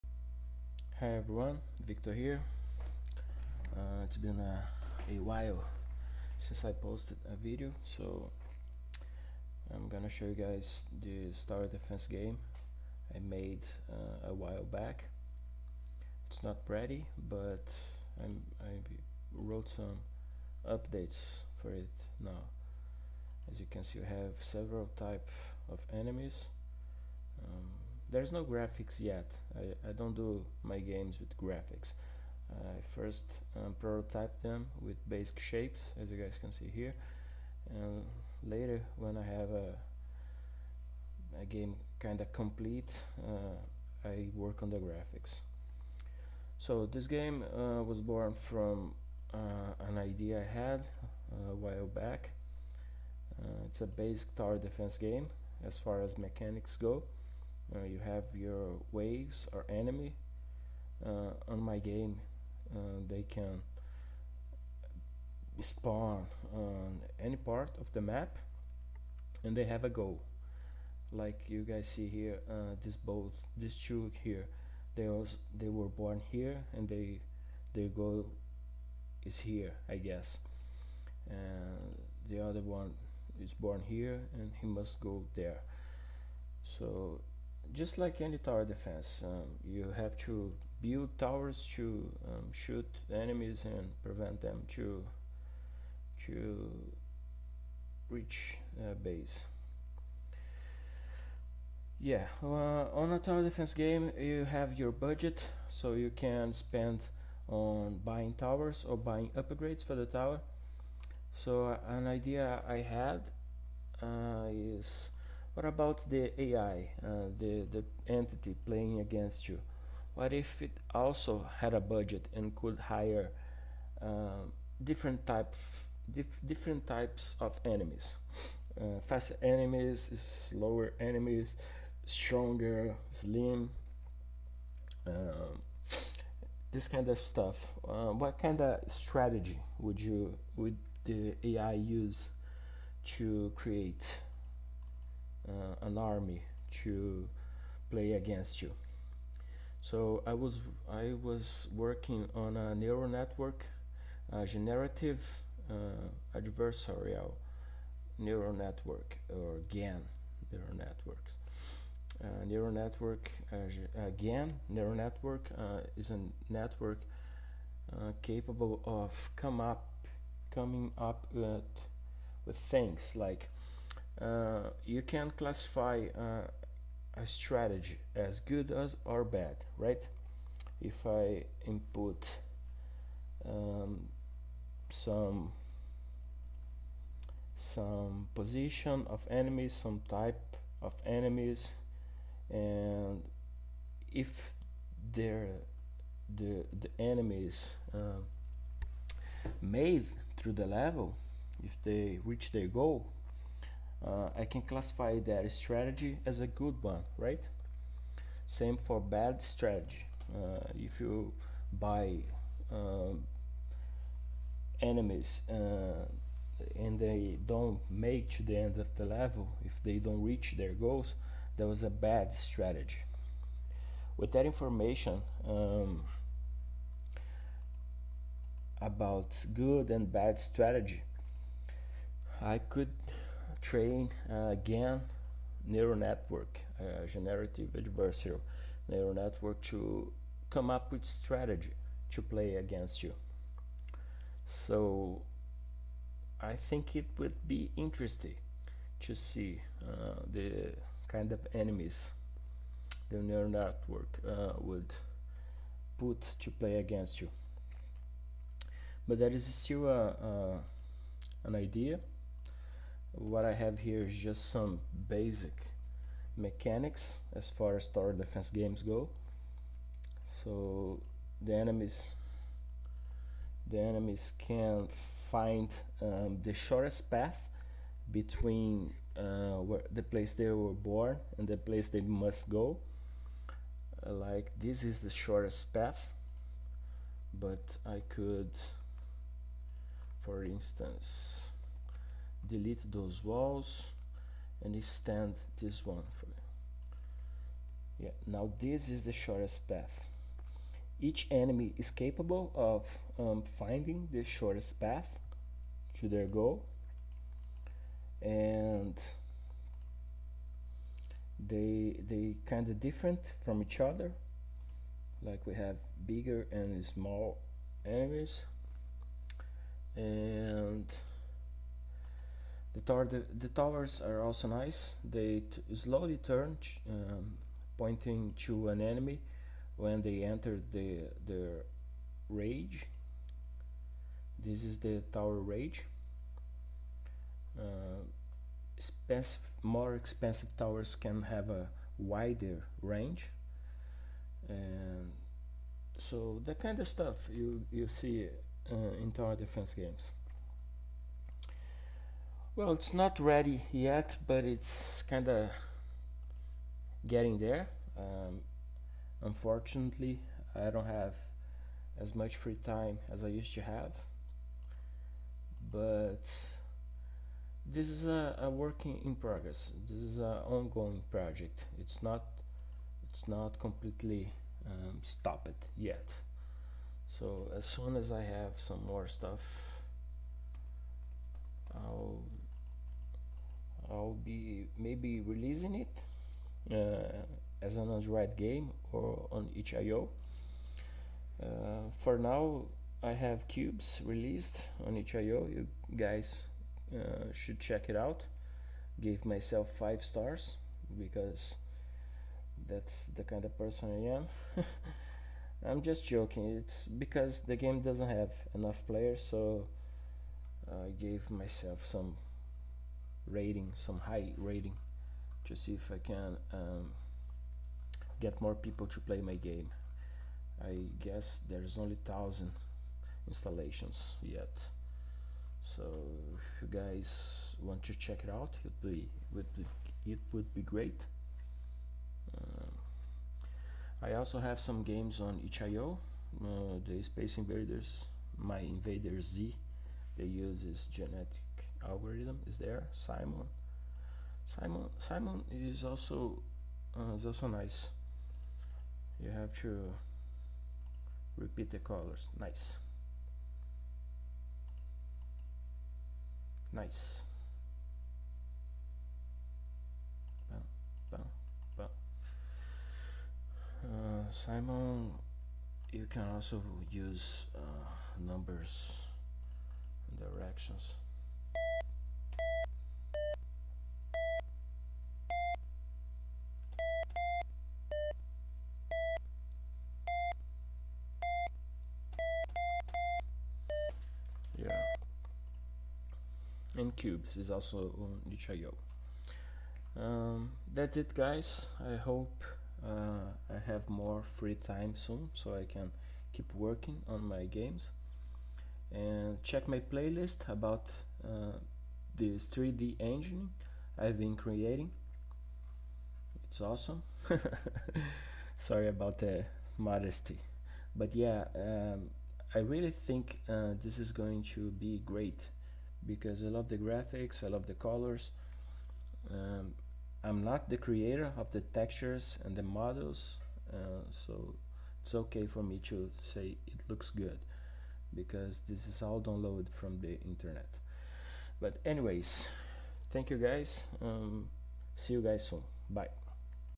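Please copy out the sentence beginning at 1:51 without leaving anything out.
So uh, an idea I had uh, is what about the AI, uh, the, the entity playing against you?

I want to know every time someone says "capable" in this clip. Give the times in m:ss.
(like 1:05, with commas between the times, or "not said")
2:48, 5:01.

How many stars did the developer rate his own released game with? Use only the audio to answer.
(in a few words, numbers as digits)
5.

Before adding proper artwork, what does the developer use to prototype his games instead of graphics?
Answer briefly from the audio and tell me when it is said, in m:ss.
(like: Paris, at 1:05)
basic shapes, at 0:35.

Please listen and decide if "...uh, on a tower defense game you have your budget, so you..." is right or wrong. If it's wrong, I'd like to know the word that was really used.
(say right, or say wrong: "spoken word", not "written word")
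right.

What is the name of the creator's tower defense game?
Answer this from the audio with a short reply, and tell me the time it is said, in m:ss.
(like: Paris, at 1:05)
Star Defense, at 0:11.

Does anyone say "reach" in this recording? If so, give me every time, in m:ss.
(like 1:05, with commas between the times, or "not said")
1:38, 3:22, 3:40.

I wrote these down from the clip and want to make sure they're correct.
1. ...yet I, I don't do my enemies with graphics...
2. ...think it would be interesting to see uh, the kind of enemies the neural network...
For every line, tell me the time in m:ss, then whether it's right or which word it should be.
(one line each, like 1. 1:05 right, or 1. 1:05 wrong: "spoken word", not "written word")
1. 0:28 wrong: "games", not "enemies"
2. 4:06 right.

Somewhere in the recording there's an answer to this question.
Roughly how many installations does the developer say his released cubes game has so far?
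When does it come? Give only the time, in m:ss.
7:02.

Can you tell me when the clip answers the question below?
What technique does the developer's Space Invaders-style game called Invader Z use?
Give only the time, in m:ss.
7:20.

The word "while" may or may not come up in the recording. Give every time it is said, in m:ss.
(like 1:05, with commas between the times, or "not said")
0:05, 0:14, 0:51.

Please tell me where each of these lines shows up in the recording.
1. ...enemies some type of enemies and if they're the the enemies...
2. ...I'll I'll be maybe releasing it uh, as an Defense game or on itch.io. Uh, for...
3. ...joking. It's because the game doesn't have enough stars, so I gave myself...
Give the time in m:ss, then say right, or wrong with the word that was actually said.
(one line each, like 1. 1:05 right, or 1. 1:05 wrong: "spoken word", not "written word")
1. 3:09 right
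2. 6:21 wrong: "Android", not "Defense"
3. 6:46 wrong: "players", not "stars".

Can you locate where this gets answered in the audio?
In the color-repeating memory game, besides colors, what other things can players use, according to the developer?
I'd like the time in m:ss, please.
7:48.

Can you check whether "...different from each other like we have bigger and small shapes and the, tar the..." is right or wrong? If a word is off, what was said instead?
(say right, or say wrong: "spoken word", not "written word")
wrong: "enemies", not "shapes".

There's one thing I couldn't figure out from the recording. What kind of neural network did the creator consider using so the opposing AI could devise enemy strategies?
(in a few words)
generative adversarial neural network.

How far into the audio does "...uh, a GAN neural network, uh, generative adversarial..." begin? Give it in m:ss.
3:54.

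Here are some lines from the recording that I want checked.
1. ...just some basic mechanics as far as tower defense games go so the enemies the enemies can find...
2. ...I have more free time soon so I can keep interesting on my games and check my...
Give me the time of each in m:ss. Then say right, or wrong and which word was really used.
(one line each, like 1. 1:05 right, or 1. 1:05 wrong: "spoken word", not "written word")
1. 4:24 right
2. 8:13 wrong: "working", not "interesting".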